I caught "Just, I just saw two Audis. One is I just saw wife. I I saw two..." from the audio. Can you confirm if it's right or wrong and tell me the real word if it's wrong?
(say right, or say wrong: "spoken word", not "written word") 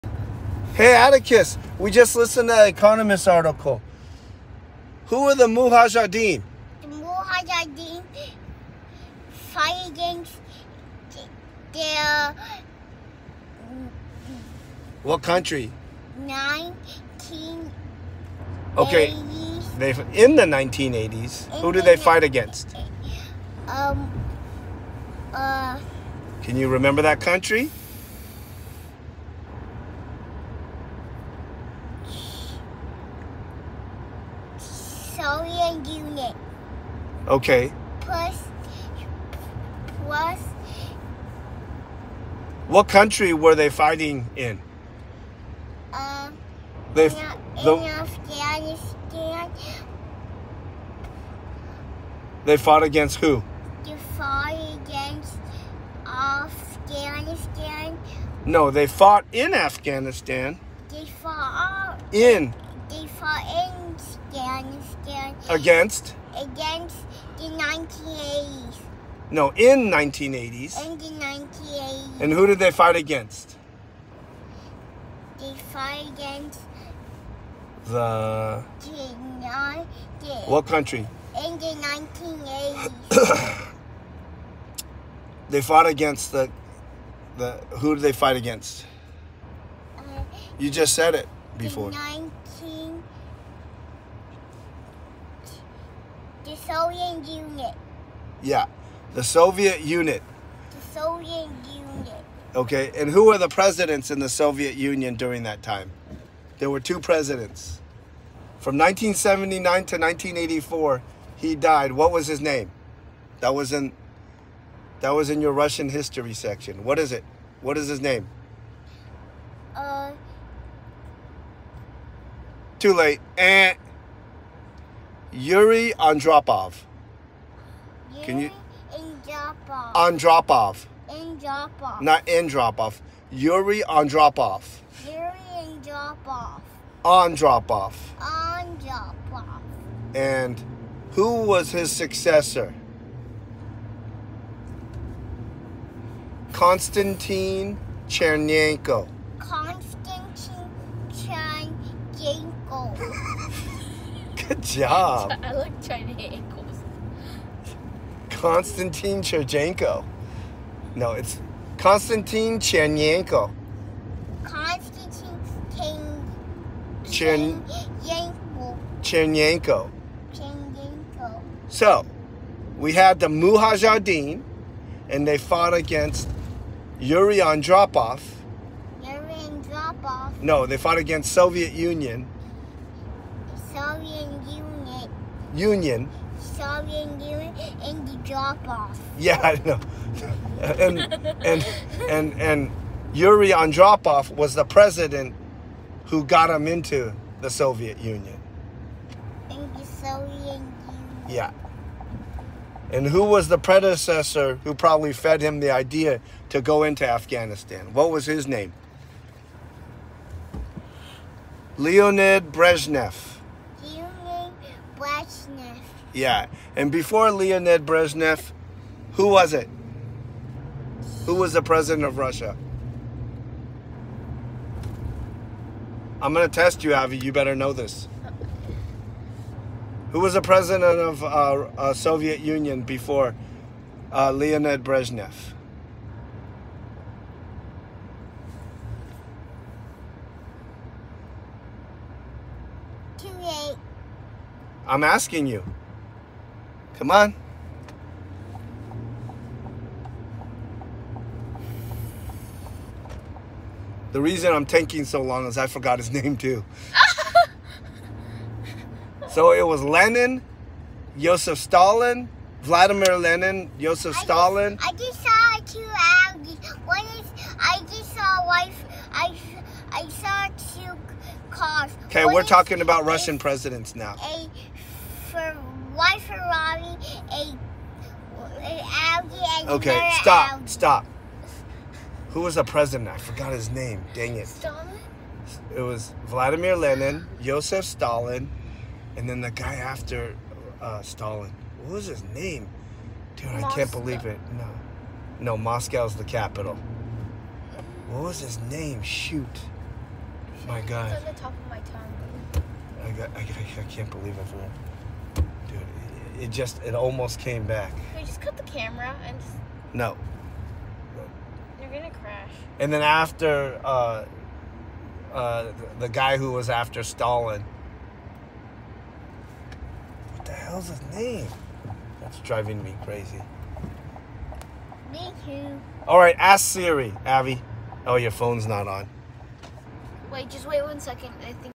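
right.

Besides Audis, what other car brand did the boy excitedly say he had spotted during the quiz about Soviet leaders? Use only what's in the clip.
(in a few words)
Ferrari.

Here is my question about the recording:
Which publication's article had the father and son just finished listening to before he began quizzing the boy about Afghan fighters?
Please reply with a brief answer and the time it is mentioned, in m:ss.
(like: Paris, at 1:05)
The Economist, at 0:02.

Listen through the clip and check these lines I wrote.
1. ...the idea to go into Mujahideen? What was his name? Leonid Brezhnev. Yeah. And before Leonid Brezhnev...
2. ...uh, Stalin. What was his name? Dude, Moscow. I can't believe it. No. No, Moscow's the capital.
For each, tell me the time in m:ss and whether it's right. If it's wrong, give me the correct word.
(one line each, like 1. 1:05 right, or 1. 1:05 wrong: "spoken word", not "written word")
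1. 3:25 wrong: "Afghanistan", not "Mujahideen"
2. 4:50 right.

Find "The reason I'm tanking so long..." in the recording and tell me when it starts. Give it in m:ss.
4:14.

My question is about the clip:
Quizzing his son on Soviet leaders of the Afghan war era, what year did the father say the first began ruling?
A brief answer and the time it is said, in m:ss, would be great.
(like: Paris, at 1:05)
1979, at 1:48.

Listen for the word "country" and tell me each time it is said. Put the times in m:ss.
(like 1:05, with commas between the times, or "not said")
0:15, 0:27, 0:42, 1:20.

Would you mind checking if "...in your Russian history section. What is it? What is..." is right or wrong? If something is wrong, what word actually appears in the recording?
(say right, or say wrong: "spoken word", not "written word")
right.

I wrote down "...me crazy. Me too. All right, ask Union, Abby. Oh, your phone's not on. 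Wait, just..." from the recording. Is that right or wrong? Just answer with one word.
wrong.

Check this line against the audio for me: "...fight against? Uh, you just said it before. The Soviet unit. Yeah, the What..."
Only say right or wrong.
wrong.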